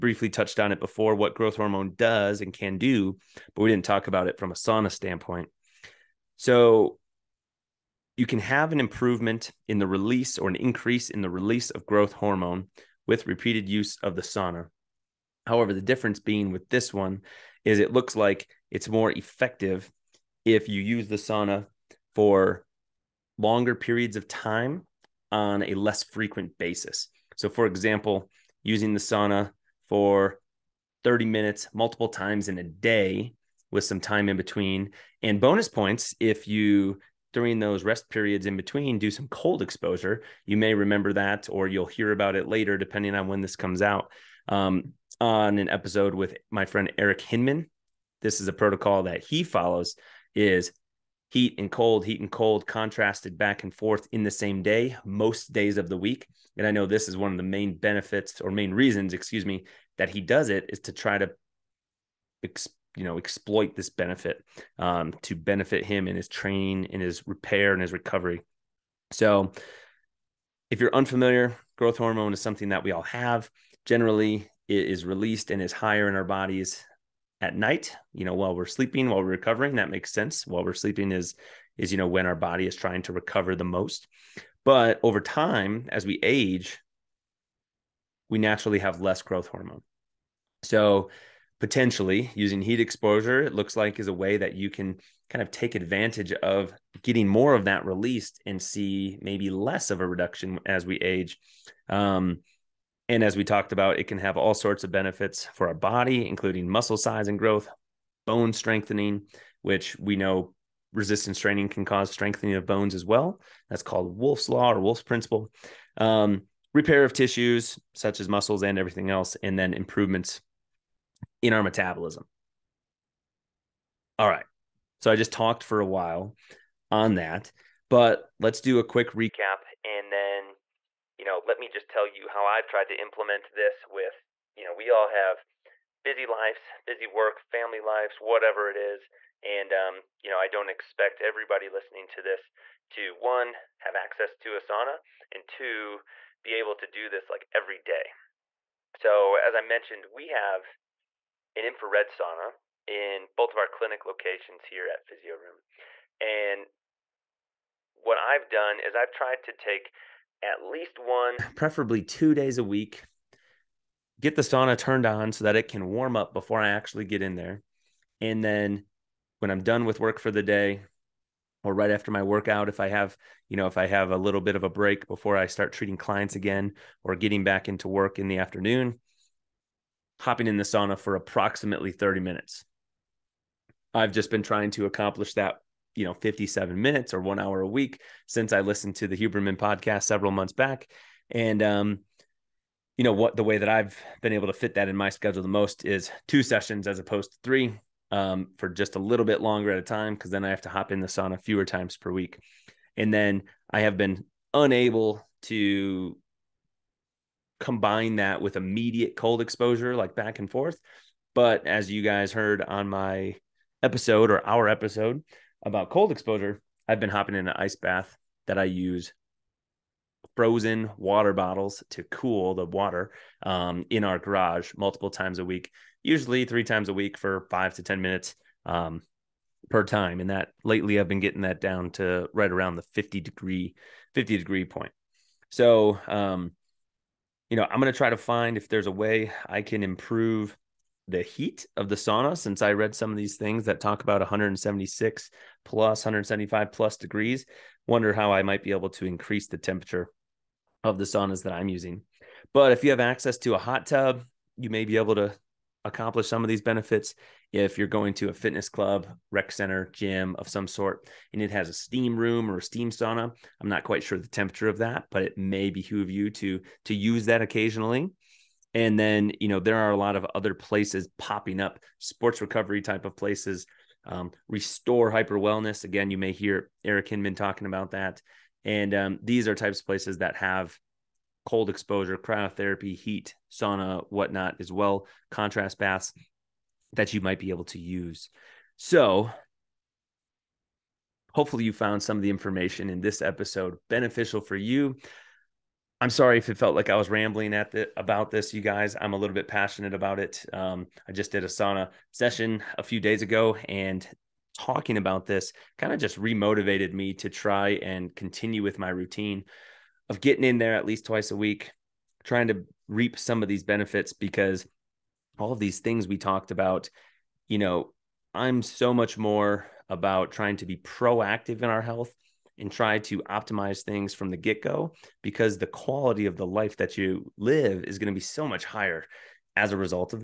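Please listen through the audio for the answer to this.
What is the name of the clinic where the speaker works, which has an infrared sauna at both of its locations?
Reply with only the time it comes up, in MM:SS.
02:35.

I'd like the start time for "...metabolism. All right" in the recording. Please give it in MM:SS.
02:01.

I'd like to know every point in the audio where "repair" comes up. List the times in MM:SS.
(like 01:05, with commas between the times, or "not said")
01:07, 01:56.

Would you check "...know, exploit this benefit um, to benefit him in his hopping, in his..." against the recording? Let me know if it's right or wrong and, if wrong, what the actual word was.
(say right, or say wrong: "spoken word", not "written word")
wrong: "training", not "hopping".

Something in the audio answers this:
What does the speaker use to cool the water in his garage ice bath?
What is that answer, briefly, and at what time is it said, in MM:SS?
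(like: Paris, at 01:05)
frozen water bottles, at 03:40.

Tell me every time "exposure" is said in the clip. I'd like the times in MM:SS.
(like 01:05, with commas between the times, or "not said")
00:39, 01:32, 03:29, 03:36, 04:41.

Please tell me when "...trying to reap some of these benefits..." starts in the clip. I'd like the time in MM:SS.
05:12.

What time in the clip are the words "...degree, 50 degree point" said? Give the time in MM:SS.
03:53.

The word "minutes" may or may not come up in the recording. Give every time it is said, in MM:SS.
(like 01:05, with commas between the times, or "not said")
00:31, 03:02, 03:06, 03:48.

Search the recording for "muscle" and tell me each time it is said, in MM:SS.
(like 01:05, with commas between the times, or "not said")
01:46, 01:58.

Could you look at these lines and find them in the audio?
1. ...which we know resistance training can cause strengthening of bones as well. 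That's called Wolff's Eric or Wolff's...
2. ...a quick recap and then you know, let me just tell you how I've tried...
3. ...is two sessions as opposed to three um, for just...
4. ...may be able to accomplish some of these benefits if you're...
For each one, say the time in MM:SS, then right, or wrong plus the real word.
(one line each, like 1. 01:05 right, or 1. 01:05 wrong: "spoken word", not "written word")
1. 01:49 wrong: "Law", not "Eric"
2. 02:08 right
3. 03:15 right
4. 04:14 right.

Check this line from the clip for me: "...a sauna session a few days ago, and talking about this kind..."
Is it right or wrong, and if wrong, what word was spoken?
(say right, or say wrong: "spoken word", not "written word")
right.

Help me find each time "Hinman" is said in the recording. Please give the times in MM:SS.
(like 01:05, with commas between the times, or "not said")
00:47, 04:37.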